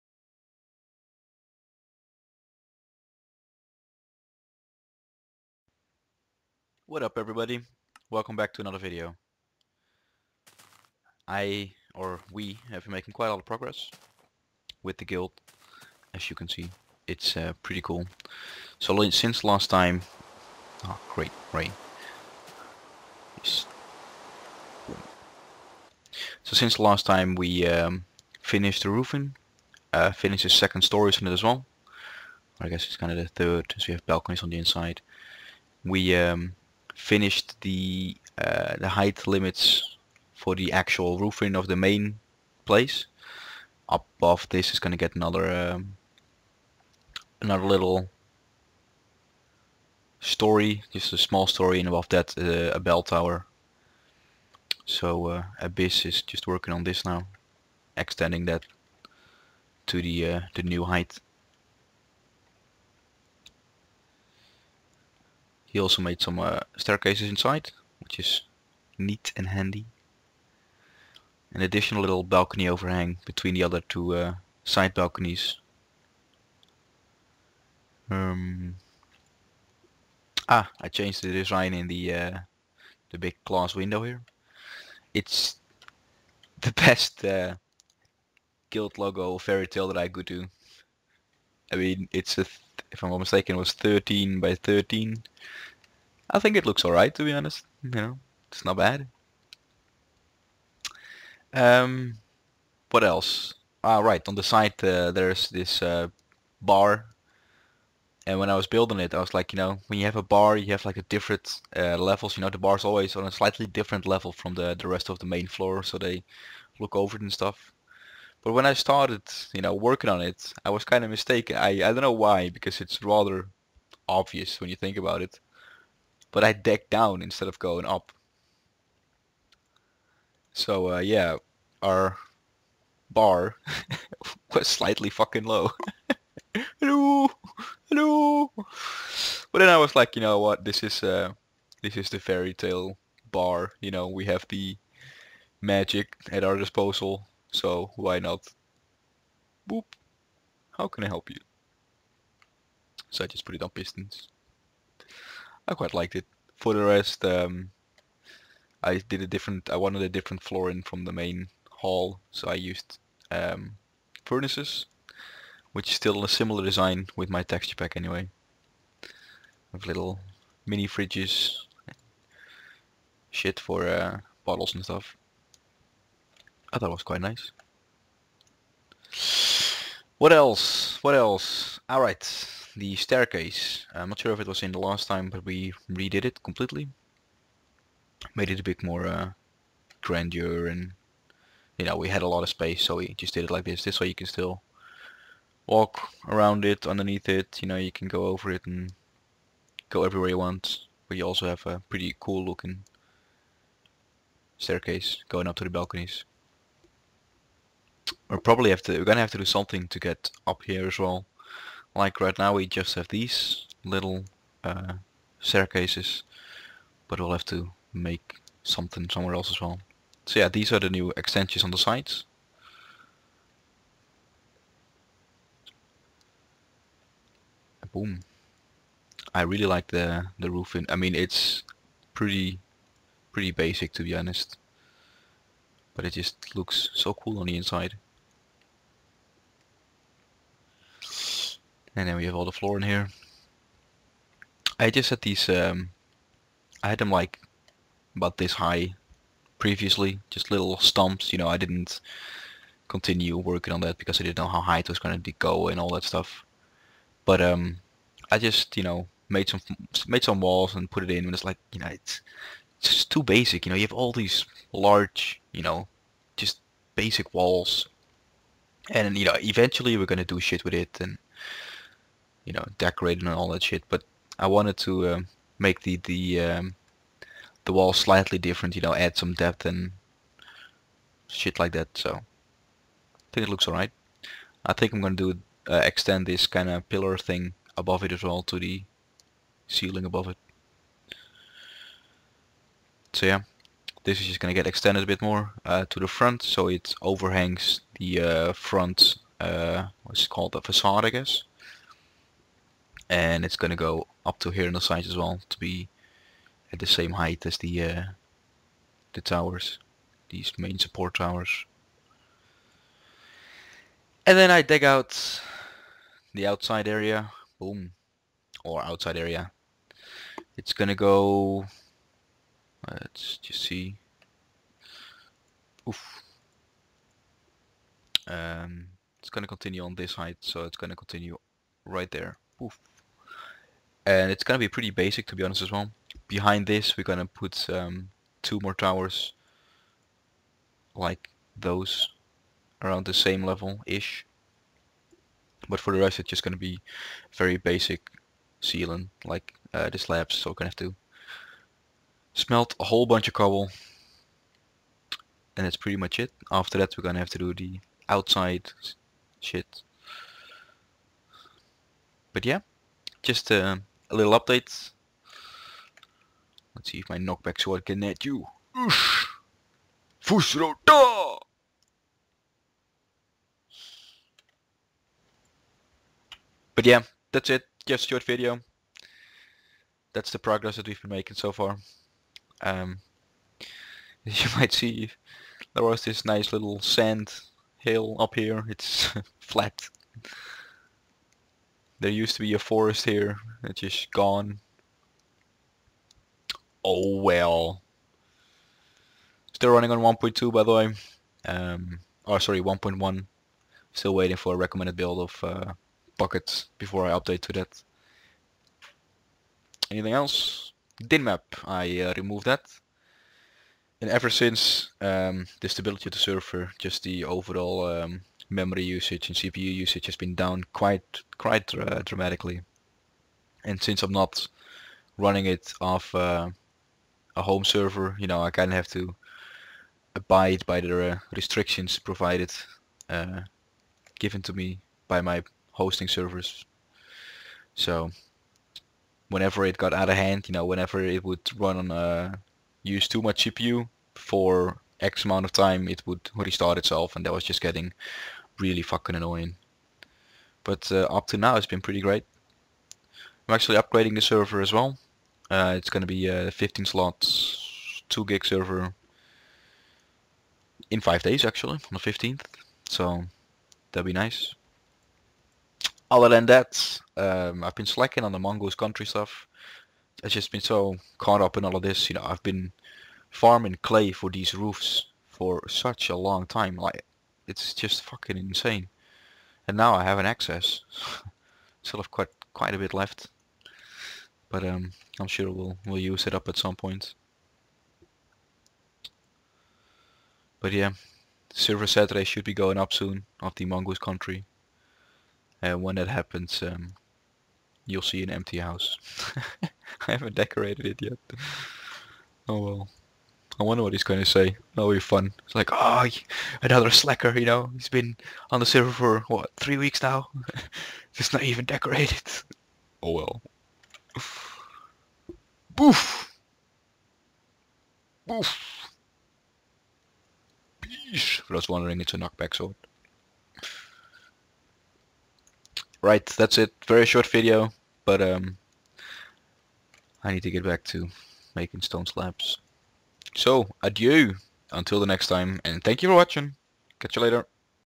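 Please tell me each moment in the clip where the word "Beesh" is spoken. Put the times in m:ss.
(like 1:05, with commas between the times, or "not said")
8:40.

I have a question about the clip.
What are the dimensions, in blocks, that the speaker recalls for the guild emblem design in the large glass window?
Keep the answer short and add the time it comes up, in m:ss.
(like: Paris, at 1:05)
13 by 13, at 1:33.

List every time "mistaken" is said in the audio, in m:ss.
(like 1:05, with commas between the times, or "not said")
1:33, 2:01.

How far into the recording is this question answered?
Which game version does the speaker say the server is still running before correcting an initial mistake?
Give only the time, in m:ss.
6:42.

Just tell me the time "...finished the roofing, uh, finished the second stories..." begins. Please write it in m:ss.
0:28.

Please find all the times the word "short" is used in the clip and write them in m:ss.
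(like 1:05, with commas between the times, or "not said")
6:18, 8:47.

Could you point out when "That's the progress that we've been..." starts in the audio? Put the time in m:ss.
6:20.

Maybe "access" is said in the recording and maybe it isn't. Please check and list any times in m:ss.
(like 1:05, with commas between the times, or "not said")
8:00.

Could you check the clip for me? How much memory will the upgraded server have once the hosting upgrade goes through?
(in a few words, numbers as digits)
2 gig.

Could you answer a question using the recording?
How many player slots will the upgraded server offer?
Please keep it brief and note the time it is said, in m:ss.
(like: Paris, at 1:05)
15, at 7:36.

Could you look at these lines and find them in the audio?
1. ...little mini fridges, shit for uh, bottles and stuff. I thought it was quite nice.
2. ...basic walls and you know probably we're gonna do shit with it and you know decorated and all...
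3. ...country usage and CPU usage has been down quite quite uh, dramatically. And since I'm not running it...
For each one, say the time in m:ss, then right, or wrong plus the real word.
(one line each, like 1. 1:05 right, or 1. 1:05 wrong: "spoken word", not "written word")
1. 2:49 right
2. 4:26 wrong: "eventually", not "probably"
3. 6:58 wrong: "memory", not "country".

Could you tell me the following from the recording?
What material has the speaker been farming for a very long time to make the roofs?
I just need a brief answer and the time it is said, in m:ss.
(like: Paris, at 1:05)
Clay, at 7:53.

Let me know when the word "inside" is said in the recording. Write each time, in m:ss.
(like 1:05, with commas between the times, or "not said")
0:34, 1:07, 3:57.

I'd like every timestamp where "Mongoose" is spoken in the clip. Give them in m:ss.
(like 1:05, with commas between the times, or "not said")
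7:48, 8:13.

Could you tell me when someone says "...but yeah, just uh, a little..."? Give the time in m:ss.
6:02.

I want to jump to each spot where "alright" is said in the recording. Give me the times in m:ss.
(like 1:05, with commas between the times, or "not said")
1:36, 3:01, 4:43.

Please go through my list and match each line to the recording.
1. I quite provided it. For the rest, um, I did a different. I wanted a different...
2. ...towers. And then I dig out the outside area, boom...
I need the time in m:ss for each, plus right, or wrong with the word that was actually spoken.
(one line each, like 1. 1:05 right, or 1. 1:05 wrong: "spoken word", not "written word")
1. 2:35 wrong: "liked", not "provided"
2. 5:11 right.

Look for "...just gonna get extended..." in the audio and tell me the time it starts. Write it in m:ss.
4:54.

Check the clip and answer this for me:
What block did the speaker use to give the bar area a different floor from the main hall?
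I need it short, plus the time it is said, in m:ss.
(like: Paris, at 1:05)
Furnaces, at 2:44.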